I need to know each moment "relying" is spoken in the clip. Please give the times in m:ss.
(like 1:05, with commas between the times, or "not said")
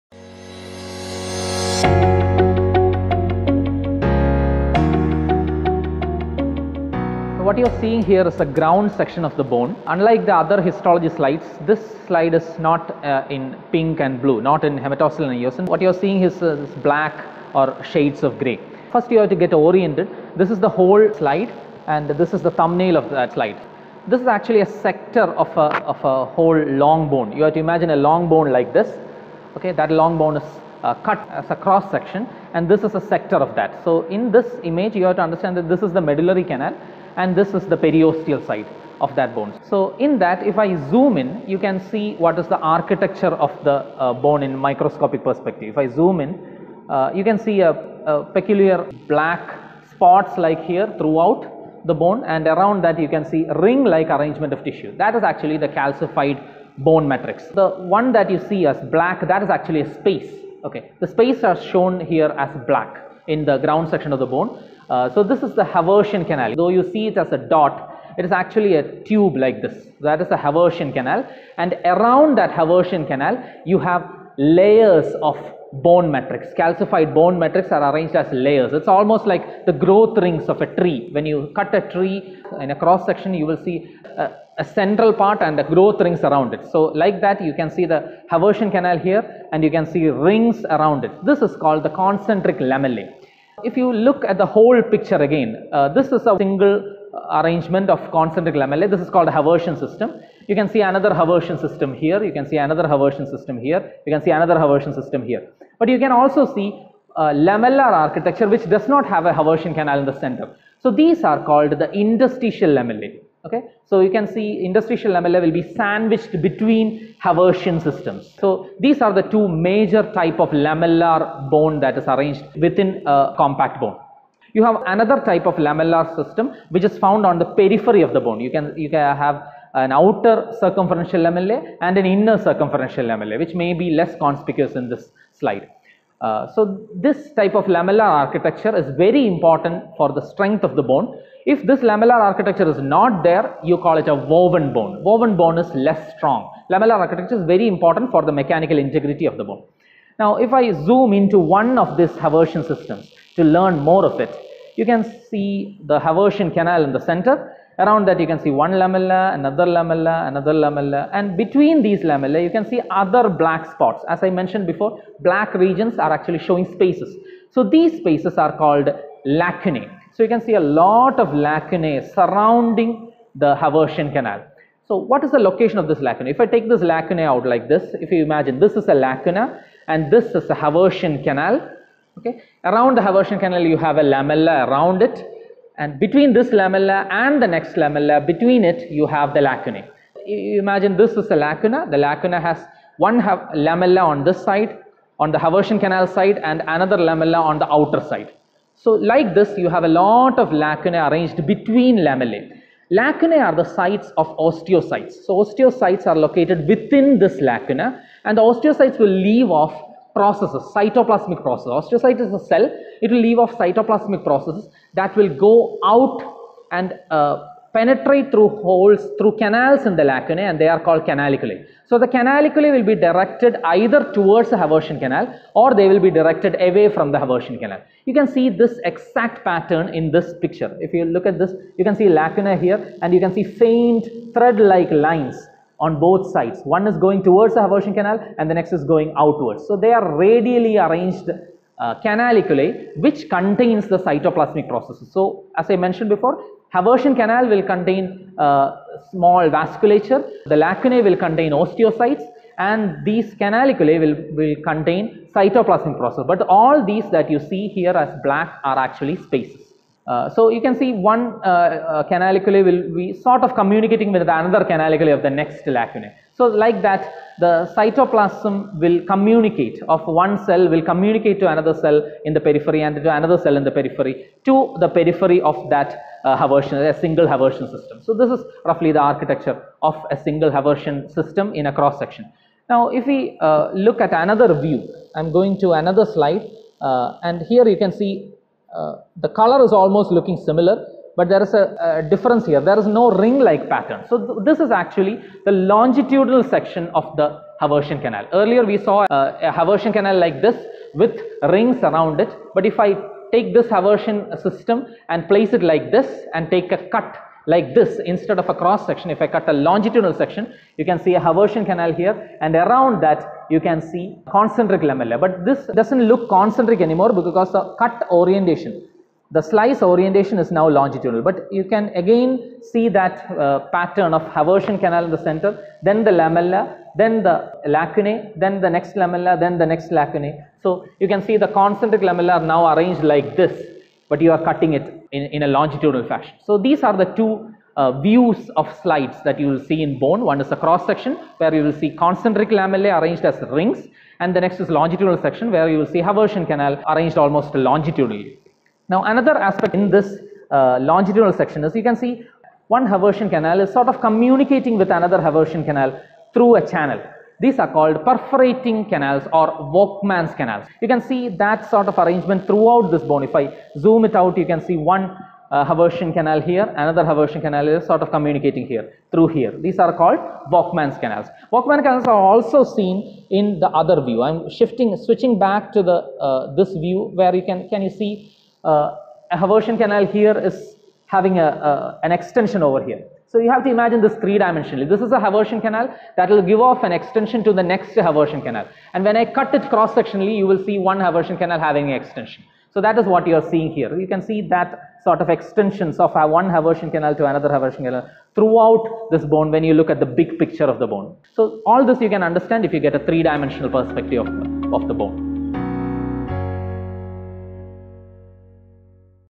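not said.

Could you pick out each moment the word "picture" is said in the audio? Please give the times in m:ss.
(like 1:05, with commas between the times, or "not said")
1:34, 3:50, 6:40.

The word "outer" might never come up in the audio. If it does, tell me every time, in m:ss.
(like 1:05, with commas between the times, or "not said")
2:09, 3:17.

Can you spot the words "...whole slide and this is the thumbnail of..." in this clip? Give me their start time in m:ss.
0:20.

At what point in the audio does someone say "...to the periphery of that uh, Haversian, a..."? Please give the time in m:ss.
4:34.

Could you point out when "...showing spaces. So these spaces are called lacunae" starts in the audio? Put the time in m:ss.
2:46.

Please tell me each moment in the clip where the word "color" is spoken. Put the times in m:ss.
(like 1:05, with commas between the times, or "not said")
4:49.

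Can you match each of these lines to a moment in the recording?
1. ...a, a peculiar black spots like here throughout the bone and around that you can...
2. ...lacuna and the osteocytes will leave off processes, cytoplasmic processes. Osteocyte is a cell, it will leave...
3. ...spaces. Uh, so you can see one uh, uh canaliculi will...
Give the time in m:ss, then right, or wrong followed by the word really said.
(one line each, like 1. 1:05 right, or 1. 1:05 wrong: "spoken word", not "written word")
1. 0:47 right
2. 3:27 right
3. 4:19 right.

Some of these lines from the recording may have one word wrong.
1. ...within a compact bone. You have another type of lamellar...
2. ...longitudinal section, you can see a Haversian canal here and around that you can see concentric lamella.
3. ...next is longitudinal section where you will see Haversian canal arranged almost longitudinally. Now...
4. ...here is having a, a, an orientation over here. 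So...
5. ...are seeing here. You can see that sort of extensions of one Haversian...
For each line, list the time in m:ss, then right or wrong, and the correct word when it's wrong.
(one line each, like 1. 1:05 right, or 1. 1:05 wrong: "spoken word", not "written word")
1. 2:02 right
2. 5:09 right
3. 5:44 right
4. 6:20 wrong: "extension", not "orientation"
5. 6:33 right.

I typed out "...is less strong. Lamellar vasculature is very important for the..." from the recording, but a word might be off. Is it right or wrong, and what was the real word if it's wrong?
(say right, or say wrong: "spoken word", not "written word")
wrong: "architecture", not "vasculature".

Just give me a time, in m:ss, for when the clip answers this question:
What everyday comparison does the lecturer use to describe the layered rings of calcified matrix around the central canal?
1:19.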